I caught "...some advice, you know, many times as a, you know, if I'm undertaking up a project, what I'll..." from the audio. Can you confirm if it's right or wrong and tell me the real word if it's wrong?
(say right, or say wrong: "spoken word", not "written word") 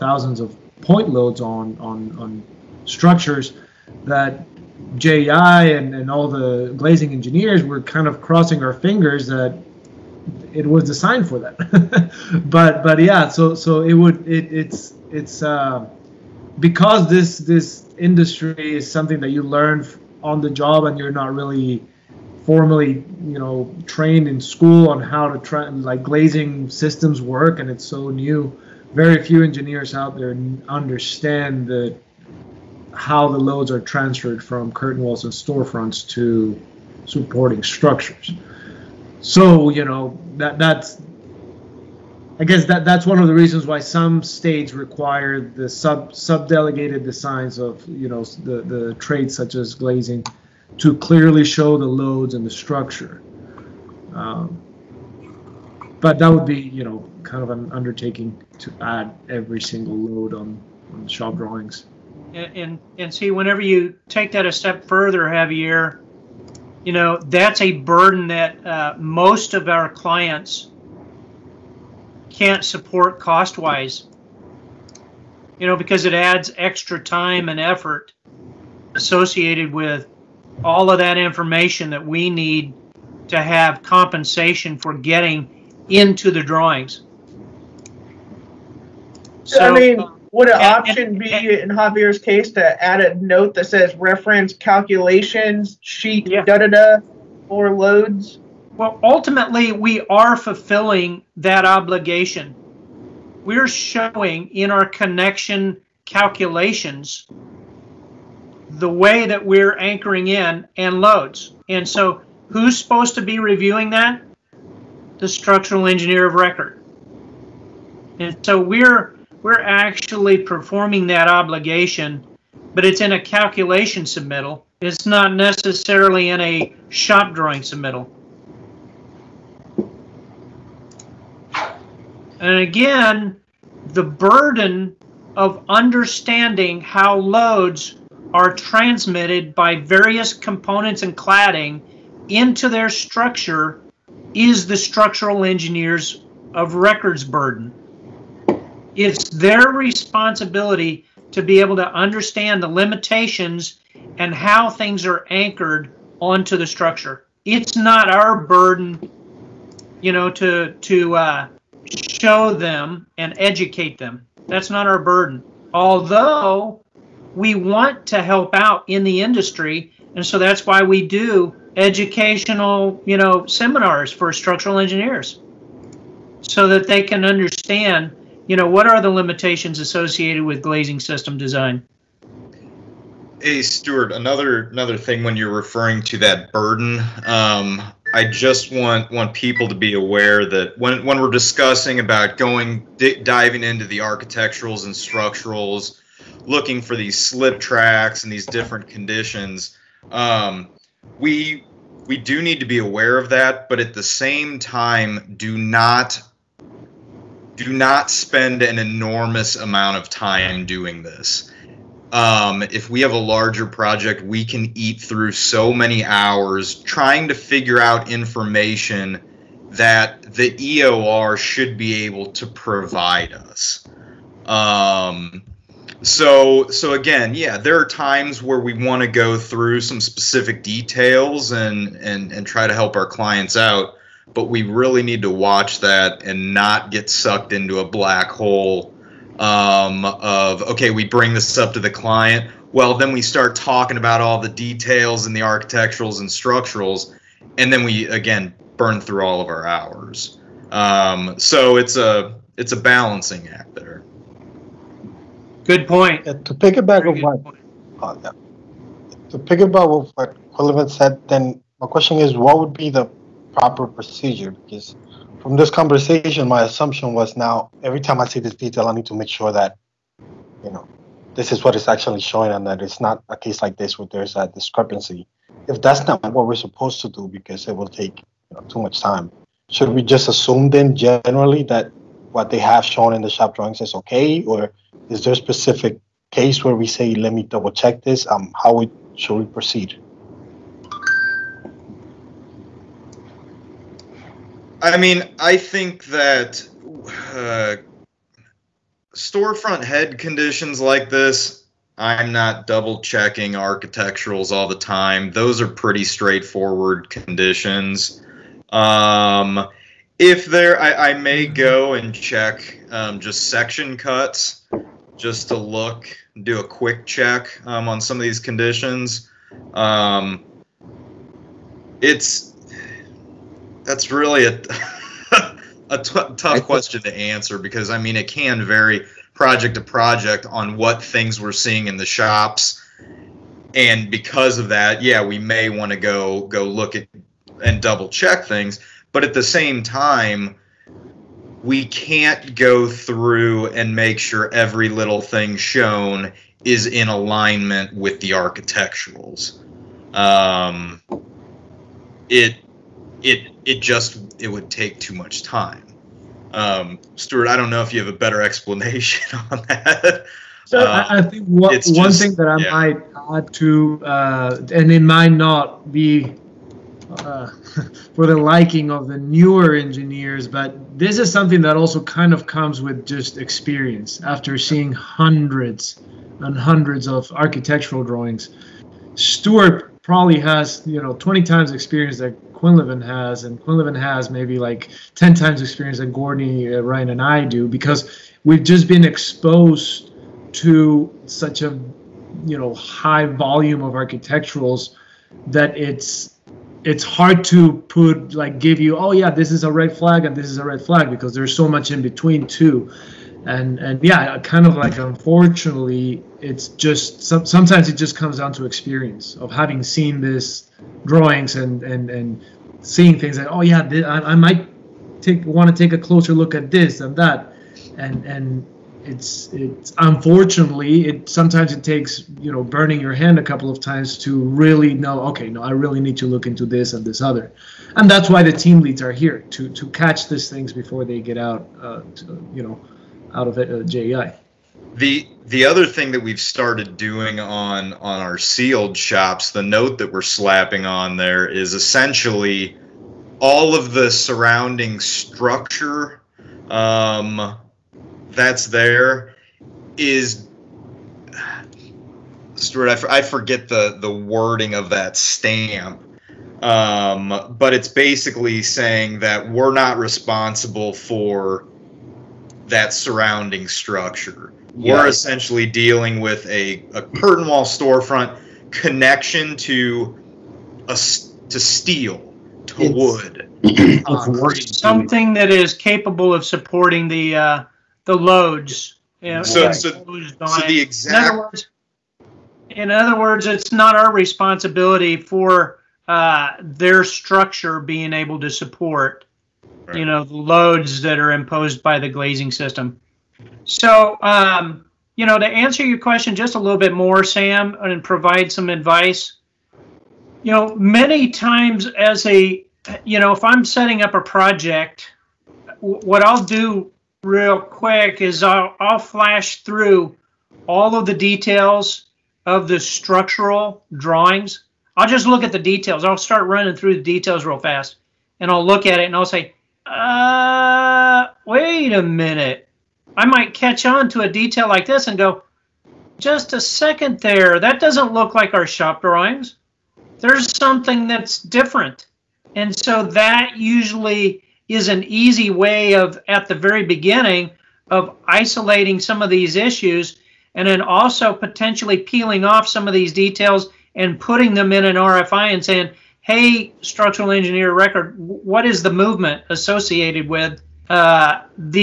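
wrong: "setting", not "undertaking".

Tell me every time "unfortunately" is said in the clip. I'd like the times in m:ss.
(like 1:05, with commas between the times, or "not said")
6:44, 6:59.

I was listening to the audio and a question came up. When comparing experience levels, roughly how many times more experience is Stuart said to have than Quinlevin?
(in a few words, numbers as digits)
20 times.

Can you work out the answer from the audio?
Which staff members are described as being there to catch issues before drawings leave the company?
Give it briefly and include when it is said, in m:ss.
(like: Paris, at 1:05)
team leads, at 7:08.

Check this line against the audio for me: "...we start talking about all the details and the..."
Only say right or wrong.
right.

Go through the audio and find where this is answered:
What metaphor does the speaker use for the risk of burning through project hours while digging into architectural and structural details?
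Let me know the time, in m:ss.
3:57.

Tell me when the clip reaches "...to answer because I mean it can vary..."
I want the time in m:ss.
5:26.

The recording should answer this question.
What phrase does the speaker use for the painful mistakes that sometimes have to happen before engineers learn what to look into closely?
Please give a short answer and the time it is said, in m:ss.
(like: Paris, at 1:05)
burning your hand, at 7:02.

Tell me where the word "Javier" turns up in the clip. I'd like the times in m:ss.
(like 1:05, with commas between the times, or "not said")
1:05, 1:31.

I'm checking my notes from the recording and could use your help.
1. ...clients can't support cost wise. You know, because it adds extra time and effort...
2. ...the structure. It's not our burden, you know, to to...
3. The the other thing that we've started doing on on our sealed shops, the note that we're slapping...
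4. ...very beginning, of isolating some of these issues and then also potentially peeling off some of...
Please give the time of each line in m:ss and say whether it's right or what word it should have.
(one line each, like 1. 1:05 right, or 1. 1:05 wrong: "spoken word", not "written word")
1. 1:09 right
2. 2:36 right
3. 7:14 right
4. 8:56 right.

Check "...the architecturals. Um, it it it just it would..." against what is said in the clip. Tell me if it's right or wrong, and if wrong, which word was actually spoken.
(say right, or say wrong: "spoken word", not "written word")
right.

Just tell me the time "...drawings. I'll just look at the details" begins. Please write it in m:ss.
8:33.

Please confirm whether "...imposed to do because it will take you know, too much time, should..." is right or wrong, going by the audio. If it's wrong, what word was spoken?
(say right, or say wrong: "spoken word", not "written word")
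wrong: "supposed", not "imposed".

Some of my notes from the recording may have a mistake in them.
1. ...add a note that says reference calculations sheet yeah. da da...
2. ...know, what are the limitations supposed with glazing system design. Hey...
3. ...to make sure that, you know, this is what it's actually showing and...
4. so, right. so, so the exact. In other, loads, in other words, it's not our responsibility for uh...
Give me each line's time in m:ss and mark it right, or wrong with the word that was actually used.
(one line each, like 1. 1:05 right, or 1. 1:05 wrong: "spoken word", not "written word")
1. 1:32 right
2. 2:58 wrong: "associated", not "supposed"
3. 4:29 right
4. 7:59 wrong: "words", not "loads".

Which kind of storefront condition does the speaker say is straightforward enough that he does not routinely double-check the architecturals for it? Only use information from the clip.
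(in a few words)
head conditions.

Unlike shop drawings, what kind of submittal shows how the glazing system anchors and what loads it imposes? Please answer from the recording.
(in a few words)
calculation submittal.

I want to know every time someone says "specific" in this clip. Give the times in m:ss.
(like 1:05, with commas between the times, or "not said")
3:49, 4:45.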